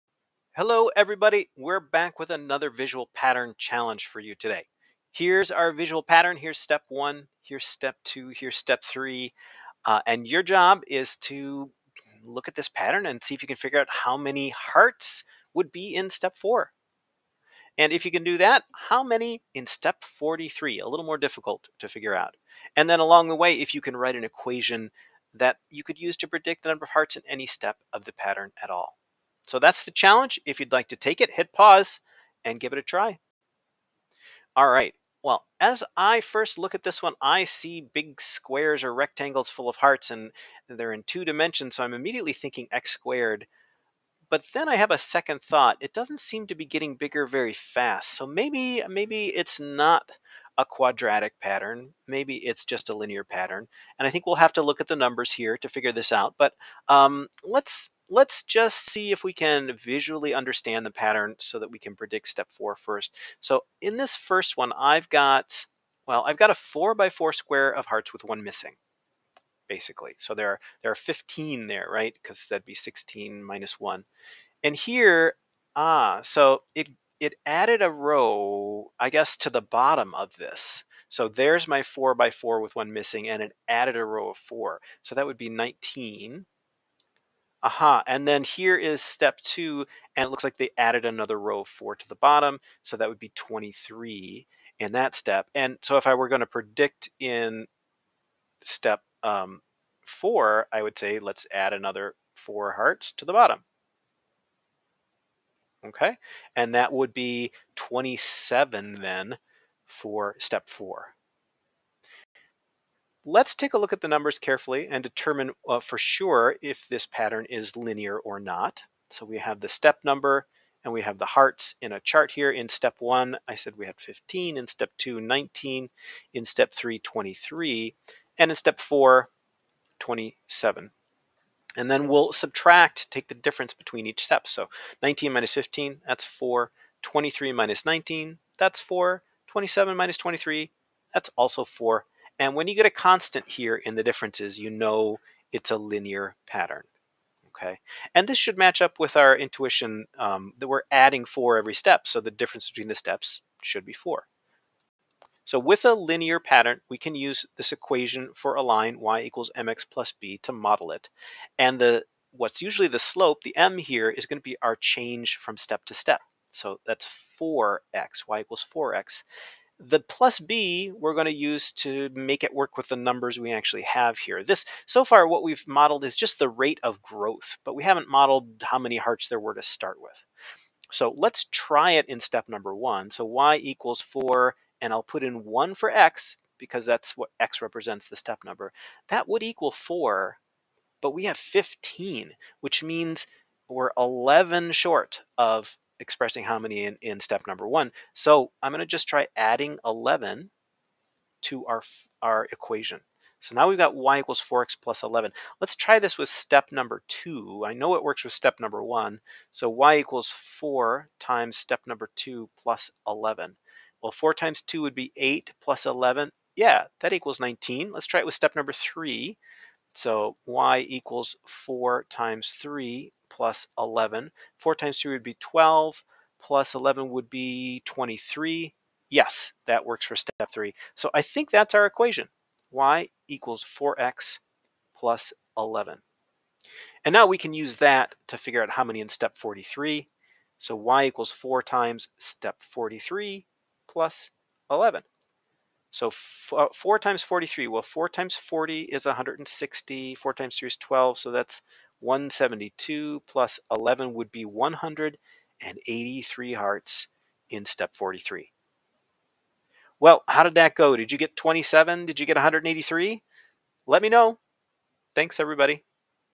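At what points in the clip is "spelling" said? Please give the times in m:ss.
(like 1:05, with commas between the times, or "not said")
not said.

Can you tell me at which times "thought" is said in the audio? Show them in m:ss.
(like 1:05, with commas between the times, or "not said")
0:45.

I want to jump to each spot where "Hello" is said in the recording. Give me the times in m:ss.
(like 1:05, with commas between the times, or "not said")
0:00.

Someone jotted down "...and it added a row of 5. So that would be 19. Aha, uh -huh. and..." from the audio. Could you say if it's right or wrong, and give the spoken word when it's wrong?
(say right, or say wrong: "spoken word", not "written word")
wrong: "4", not "5".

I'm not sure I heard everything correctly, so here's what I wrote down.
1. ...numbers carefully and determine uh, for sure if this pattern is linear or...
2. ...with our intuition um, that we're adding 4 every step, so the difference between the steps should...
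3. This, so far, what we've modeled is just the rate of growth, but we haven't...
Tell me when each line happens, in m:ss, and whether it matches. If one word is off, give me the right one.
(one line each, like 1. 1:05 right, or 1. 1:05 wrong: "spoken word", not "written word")
1. 1:54 right
2. 2:28 right
3. 2:54 right.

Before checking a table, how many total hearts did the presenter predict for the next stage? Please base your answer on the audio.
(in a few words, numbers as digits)
27.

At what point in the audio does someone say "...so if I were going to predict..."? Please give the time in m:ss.
1:35.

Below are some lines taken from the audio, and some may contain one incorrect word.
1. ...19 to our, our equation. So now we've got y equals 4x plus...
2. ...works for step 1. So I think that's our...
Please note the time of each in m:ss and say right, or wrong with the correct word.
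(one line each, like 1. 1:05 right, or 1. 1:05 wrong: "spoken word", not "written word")
1. 3:19 wrong: "11", not "19"
2. 3:49 wrong: "3", not "1".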